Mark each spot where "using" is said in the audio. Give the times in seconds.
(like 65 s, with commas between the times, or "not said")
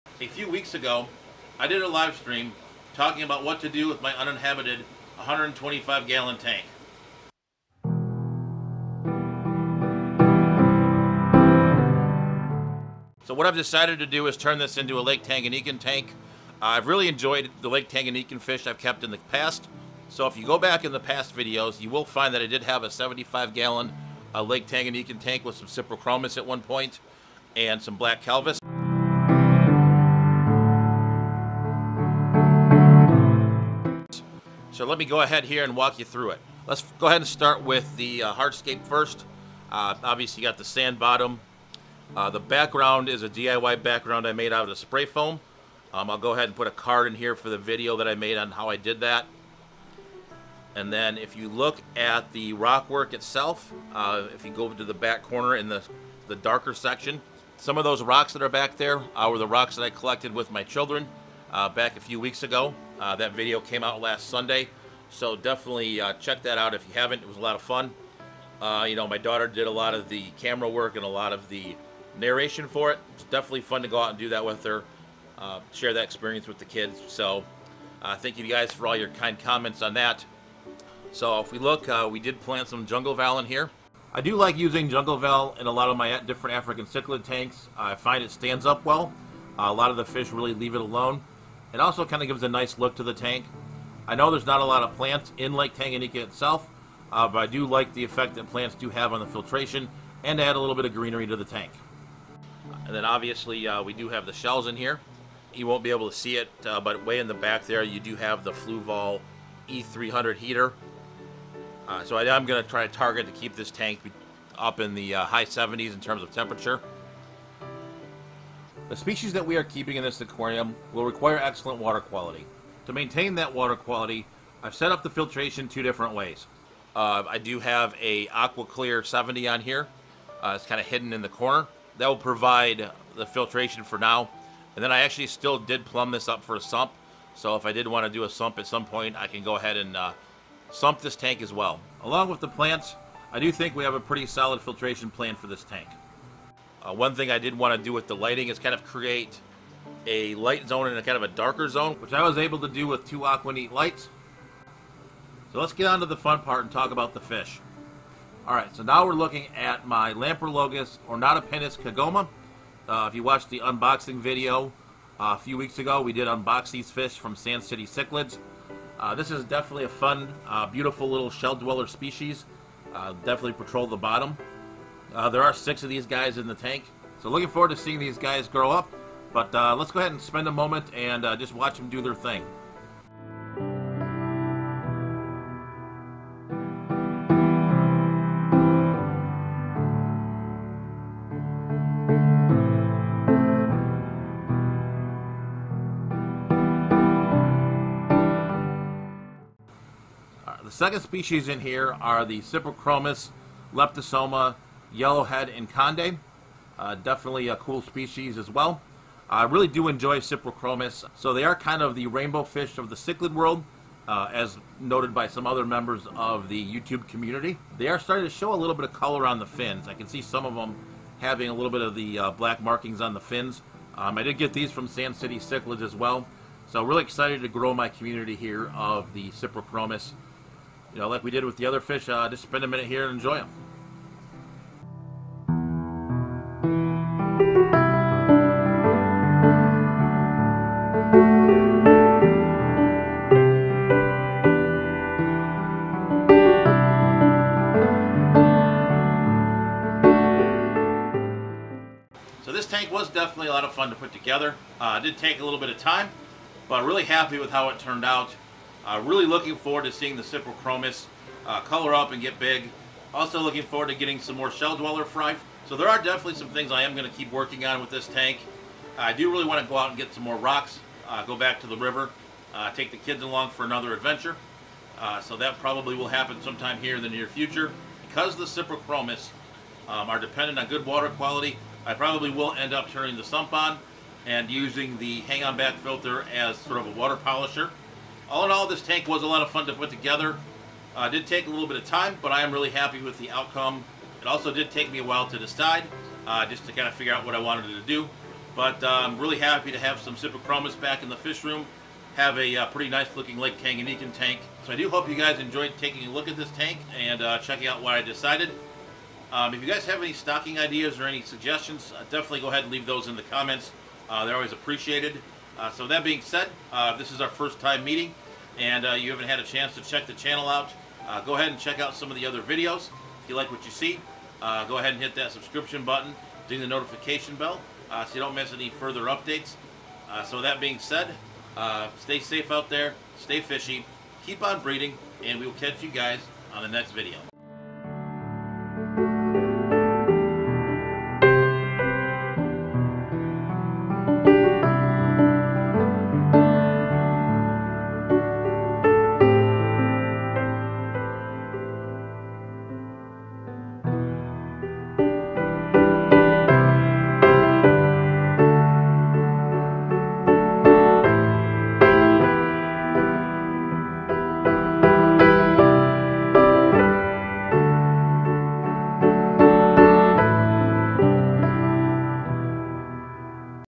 84 s, 284 s.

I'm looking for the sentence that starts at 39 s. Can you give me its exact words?
Uh, obviously, you got the sand bottom.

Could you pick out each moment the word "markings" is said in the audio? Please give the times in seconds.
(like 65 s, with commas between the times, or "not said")
222 s.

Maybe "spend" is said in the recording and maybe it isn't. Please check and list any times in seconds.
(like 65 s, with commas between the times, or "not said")
180 s, 232 s.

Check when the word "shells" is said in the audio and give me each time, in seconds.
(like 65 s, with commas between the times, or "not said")
104 s, 171 s, 264 s.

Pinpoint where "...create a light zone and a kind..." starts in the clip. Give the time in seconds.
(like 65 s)
148 s.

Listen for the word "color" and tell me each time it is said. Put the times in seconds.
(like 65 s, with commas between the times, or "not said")
218 s, 261 s.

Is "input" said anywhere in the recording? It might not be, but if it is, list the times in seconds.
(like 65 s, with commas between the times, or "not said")
not said.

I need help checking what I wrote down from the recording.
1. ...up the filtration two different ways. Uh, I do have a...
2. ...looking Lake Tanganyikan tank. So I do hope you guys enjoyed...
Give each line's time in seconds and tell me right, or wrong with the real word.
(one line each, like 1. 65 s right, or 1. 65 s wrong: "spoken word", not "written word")
1. 124 s right
2. 303 s right.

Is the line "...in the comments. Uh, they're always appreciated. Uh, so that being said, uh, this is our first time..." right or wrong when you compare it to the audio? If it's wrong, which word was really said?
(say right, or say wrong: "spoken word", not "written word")
right.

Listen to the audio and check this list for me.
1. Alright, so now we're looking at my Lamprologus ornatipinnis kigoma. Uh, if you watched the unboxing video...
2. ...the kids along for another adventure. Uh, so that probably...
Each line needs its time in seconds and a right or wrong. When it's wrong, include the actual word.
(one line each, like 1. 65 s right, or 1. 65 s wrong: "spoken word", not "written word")
1. 158 s right
2. 272 s right.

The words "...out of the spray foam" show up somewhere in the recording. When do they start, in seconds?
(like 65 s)
44 s.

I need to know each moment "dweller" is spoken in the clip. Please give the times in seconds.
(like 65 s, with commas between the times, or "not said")
171 s, 264 s.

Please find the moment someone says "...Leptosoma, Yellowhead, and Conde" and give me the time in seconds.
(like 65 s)
203 s.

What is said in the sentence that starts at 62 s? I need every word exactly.
Uh, that video came out last Sunday.